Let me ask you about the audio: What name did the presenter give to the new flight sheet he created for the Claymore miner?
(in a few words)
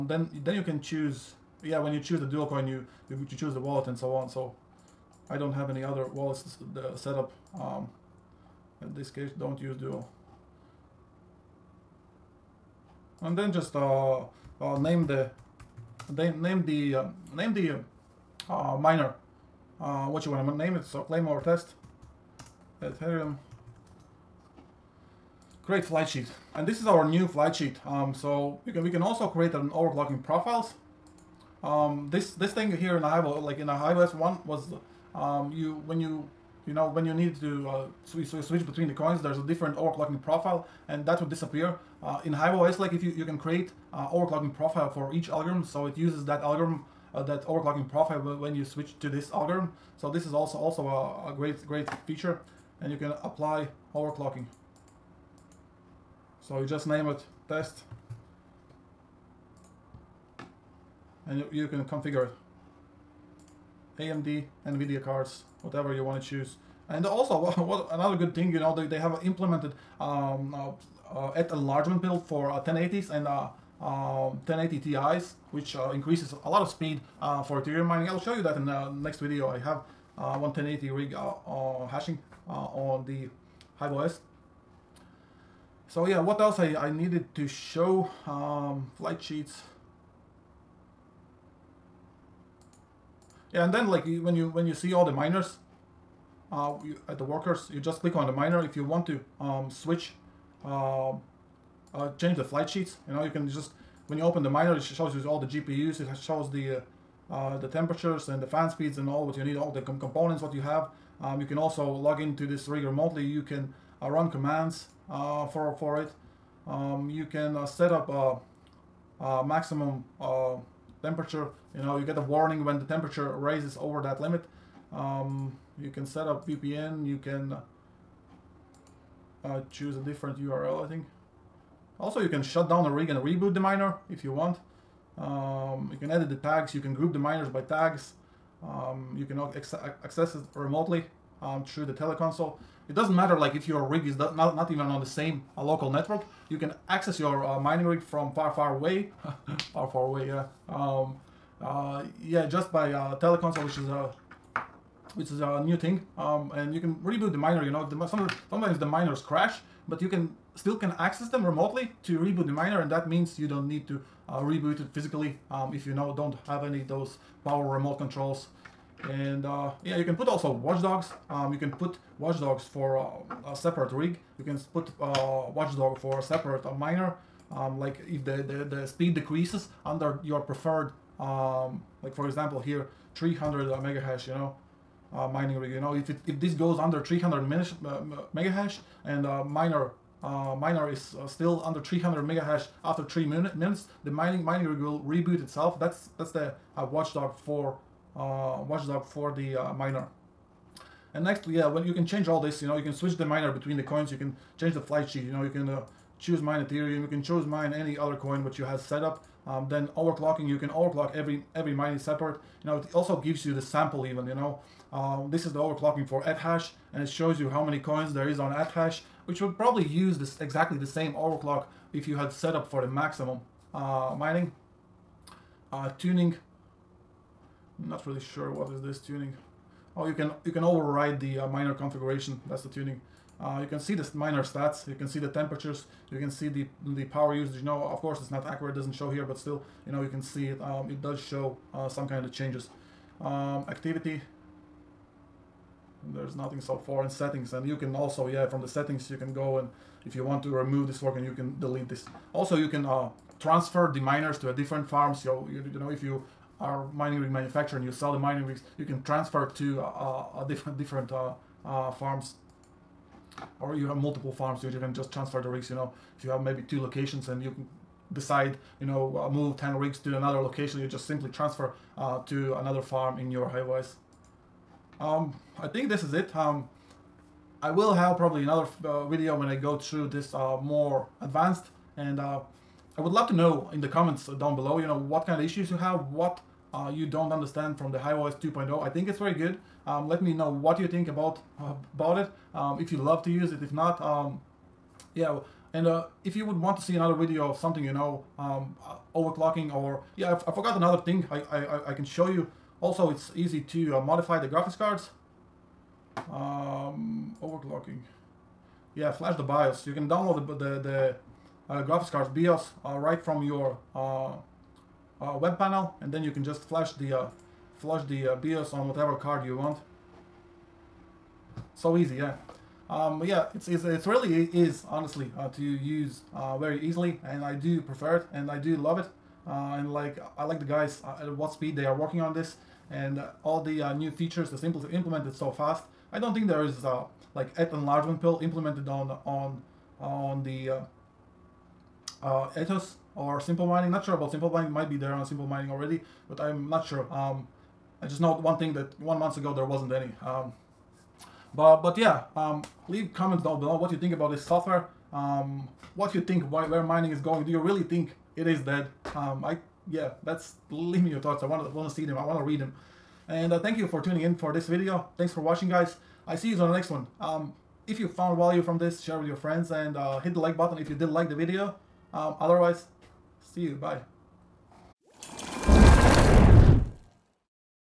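Claymore test Ethereum.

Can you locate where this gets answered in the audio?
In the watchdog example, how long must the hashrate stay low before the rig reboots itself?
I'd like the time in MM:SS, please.
03:13.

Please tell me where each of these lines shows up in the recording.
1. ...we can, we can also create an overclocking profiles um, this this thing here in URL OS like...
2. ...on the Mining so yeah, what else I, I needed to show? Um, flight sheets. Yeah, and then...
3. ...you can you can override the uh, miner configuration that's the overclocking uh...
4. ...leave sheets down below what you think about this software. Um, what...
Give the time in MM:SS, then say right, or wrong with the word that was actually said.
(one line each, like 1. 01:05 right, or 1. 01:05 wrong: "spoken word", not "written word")
1. 00:28 wrong: "Hive", not "URL"
2. 01:22 wrong: "HiveOS", not "Mining"
3. 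03:50 wrong: "tuning", not "overclocking"
4. 05:52 wrong: "comments", not "sheets".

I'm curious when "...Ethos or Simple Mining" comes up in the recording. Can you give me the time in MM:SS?
05:42.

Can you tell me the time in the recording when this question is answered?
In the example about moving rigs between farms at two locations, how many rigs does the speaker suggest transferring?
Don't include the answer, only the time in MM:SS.
04:29.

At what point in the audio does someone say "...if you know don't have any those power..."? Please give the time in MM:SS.
02:45.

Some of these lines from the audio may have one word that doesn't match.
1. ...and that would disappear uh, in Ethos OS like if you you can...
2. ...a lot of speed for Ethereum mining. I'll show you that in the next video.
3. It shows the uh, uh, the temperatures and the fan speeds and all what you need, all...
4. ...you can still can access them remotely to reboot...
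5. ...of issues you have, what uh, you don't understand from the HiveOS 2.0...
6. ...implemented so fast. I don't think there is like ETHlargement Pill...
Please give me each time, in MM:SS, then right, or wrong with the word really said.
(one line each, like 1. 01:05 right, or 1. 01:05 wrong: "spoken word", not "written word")
1. 00:40 wrong: "Hive", not "Ethos"
2. 01:16 right
3. 01:46 right
4. 02:40 right
5. 04:45 right
6. 05:34 right.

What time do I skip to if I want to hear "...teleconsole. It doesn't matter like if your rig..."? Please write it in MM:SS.
02:21.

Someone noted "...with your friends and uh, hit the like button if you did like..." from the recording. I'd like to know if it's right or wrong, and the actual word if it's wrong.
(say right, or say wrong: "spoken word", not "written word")
right.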